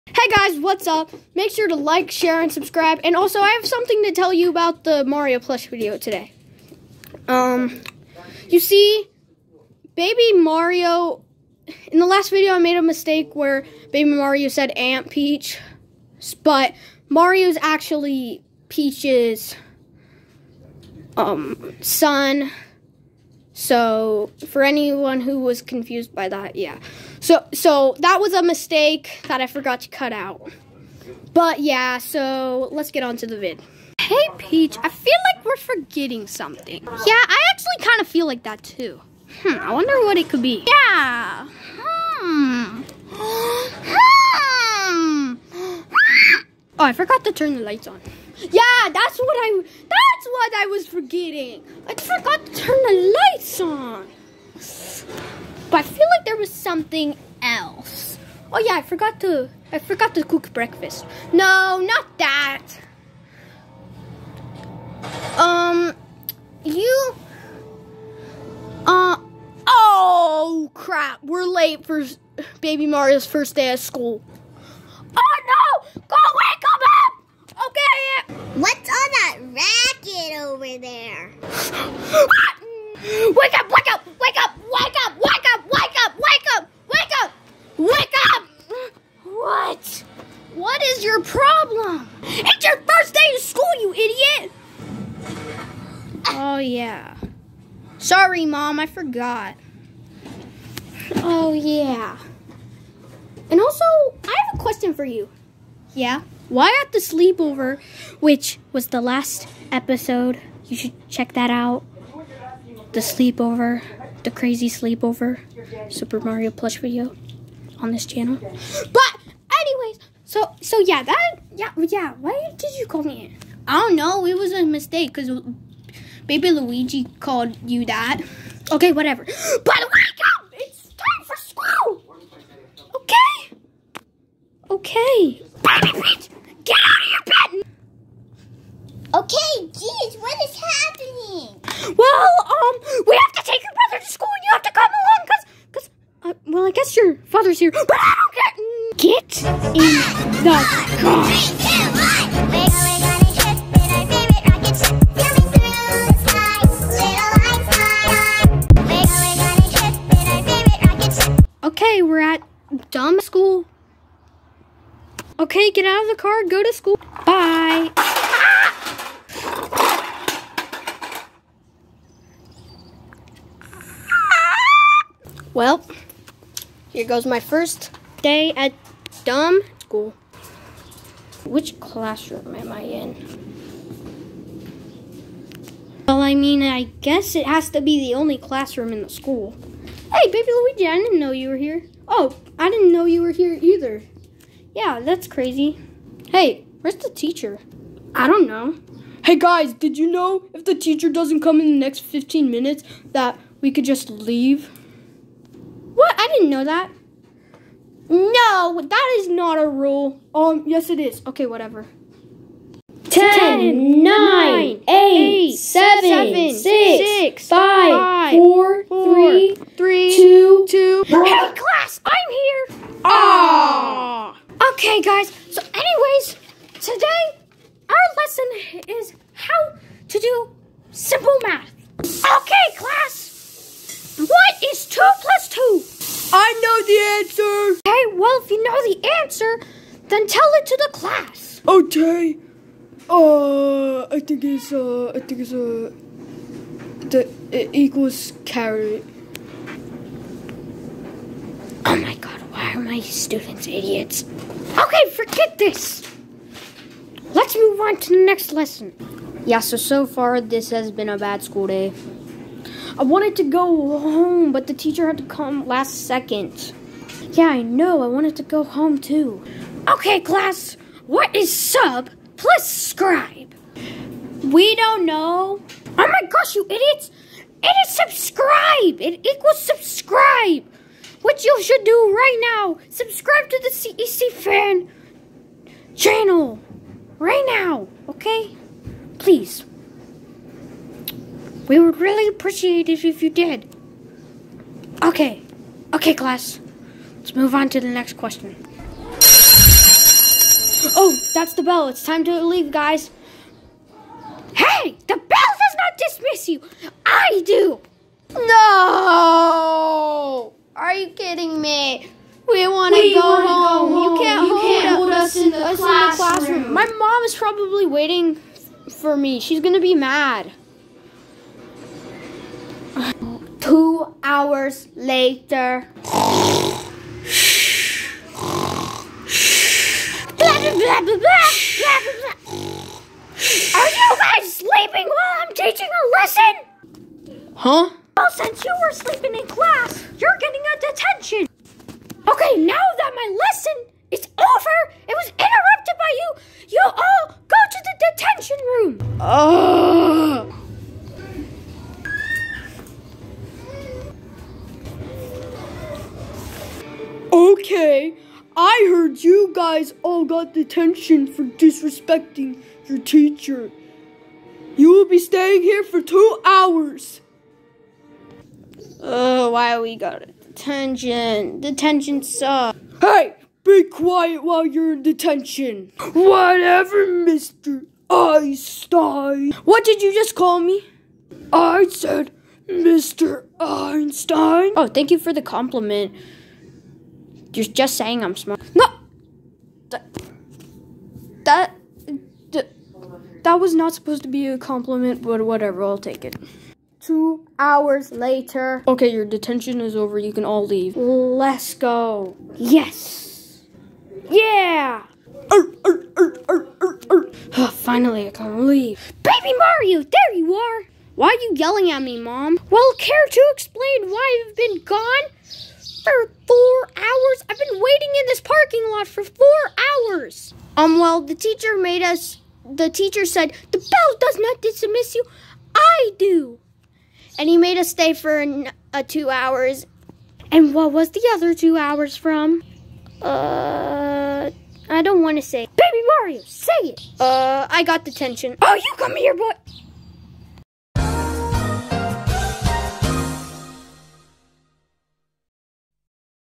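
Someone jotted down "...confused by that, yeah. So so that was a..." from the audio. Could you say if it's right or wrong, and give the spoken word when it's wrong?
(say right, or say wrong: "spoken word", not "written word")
right.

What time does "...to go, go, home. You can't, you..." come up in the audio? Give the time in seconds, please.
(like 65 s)
312 s.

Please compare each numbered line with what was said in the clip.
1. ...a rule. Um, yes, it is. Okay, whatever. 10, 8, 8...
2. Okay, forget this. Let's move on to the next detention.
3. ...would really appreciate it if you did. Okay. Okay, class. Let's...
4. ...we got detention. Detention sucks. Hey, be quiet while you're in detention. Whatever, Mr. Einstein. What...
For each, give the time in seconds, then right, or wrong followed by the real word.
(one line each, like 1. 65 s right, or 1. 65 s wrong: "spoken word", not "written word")
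1. 209 s wrong: "9", not "8"
2. 254 s wrong: "lesson", not "detention"
3. 291 s right
4. 369 s right.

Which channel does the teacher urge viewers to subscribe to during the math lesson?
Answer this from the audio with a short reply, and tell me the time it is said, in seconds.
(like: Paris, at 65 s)
CEC fan channel, at 283 s.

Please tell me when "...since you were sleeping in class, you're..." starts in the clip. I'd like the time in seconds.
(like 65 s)
338 s.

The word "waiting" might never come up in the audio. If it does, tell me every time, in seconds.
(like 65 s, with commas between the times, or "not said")
317 s, 417 s.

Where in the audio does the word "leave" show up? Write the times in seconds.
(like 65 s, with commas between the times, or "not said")
204 s, 302 s, 400 s, 408 s.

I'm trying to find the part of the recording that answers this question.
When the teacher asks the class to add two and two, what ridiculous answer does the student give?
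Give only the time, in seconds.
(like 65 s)
248 s.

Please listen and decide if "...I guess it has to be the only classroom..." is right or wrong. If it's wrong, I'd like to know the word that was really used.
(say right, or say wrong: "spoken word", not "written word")
right.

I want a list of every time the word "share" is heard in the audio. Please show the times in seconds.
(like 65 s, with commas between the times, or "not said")
2 s.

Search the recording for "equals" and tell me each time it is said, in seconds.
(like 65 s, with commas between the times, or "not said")
247 s, 279 s.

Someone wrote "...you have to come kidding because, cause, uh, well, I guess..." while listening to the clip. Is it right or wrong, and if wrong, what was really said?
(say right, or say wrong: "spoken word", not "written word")
wrong: "along", not "kidding".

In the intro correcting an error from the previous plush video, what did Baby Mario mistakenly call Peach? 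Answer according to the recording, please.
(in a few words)
Aunt Peach.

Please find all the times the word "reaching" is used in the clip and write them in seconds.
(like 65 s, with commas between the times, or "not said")
not said.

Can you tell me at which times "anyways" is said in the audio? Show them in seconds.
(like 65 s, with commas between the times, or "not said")
119 s, 225 s.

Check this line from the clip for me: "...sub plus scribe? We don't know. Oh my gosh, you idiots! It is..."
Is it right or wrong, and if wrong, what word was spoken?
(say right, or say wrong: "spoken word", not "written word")
right.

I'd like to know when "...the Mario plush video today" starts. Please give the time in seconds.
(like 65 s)
4 s.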